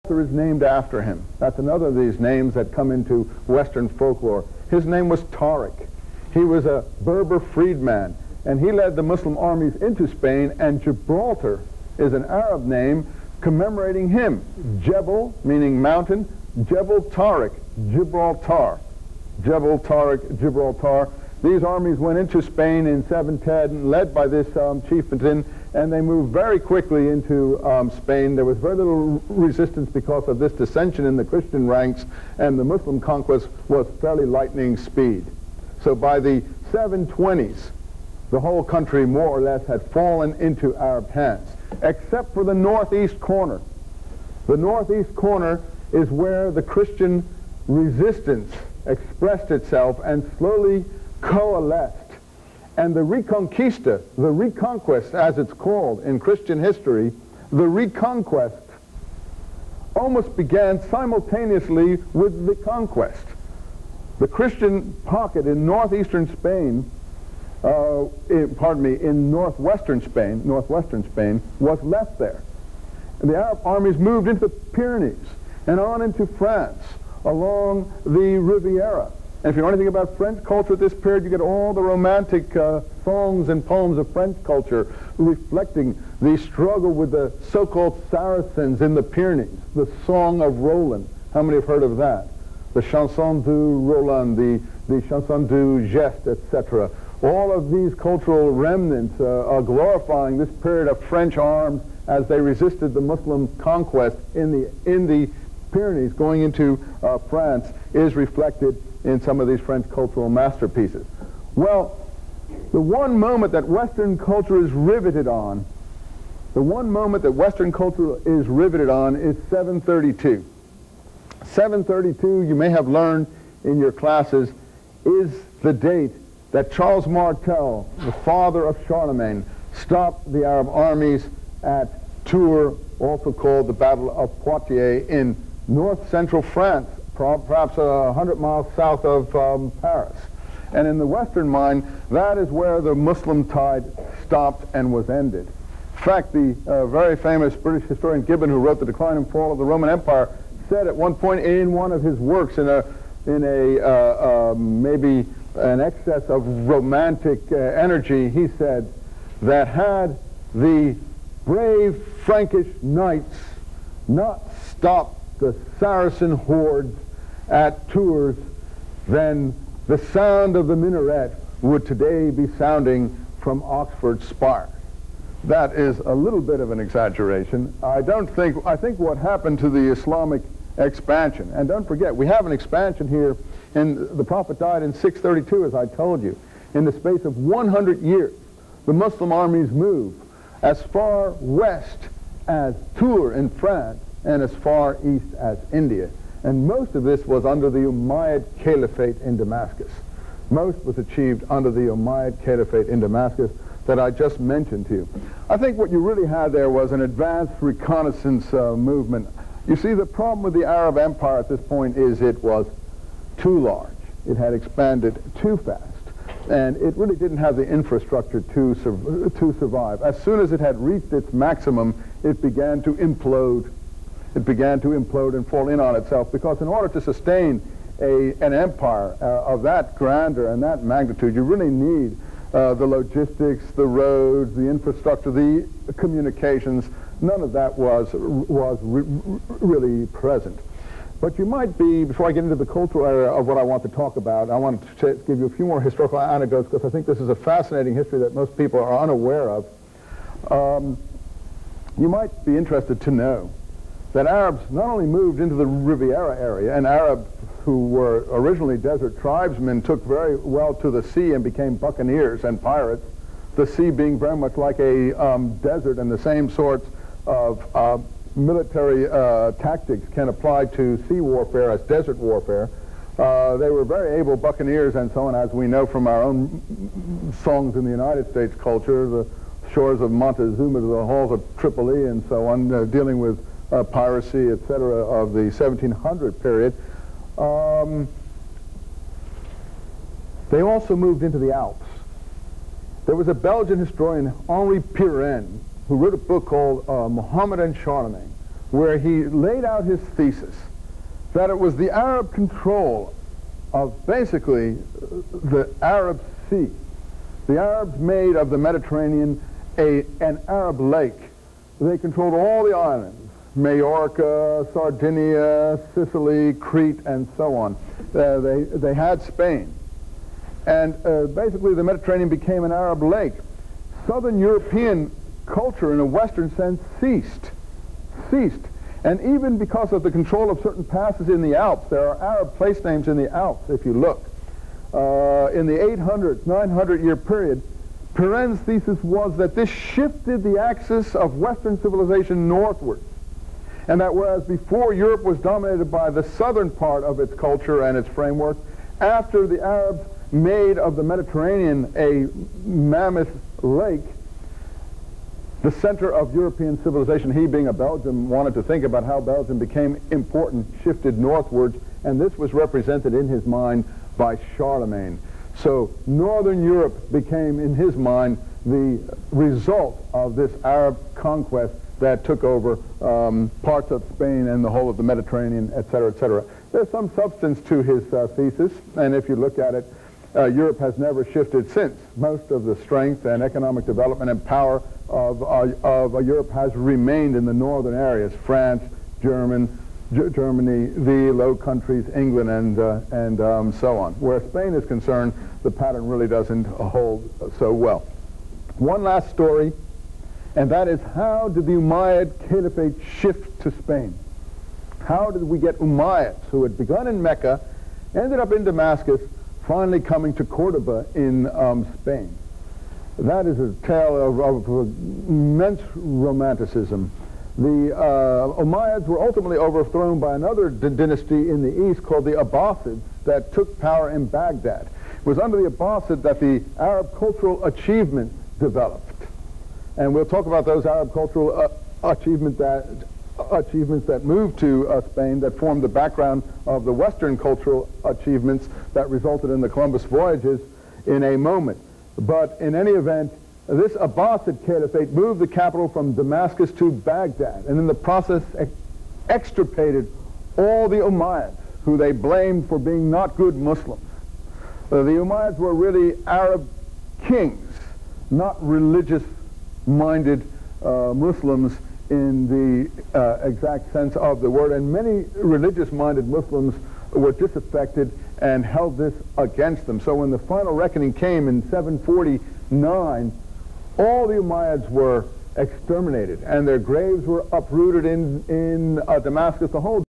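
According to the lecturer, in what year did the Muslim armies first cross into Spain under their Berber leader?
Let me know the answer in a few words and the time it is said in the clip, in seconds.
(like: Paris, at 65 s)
710, at 23 s.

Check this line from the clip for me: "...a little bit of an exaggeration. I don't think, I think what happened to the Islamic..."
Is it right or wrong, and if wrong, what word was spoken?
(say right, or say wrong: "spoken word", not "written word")
right.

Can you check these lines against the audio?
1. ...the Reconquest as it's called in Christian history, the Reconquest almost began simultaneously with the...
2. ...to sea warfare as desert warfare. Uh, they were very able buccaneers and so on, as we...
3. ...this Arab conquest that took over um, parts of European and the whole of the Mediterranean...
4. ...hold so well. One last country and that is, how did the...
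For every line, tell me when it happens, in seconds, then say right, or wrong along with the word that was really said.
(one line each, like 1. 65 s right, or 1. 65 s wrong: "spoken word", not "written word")
1. 54 s right
2. 270 s right
3. 370 s wrong: "Spain", not "European"
4. 396 s wrong: "story", not "country".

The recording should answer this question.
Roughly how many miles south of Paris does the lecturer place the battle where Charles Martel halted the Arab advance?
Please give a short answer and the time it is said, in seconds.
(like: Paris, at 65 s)
100, at 137 s.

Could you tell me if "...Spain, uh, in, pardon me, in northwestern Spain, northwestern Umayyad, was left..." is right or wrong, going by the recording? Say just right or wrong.
wrong.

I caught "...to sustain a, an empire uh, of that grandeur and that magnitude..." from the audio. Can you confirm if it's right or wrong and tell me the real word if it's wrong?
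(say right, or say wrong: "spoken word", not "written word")
right.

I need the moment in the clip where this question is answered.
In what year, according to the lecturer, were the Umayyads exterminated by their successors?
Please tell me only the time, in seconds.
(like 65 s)
471 s.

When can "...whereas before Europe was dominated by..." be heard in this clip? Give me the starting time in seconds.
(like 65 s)
344 s.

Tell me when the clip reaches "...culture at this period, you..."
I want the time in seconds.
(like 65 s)
80 s.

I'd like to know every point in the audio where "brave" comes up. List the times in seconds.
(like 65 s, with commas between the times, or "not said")
161 s.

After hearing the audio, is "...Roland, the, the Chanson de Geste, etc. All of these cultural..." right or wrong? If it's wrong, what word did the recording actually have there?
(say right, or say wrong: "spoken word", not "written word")
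right.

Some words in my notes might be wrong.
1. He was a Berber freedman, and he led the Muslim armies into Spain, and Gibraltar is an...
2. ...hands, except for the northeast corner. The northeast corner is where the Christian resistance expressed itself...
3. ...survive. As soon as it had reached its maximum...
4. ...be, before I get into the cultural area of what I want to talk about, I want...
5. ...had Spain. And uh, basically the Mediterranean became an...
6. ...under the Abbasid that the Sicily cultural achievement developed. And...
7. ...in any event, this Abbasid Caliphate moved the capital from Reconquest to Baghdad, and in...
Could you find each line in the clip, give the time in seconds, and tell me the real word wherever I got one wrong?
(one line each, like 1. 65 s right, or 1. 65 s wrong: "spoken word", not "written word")
1. 6 s right
2. 41 s right
3. 219 s right
4. 241 s right
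5. 318 s right
6. 425 s wrong: "Arab", not "Sicily"
7. 442 s wrong: "Damascus", not "Reconquest".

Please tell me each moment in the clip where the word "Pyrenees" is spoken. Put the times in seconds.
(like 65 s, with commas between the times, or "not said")
74 s, 89 s, 105 s.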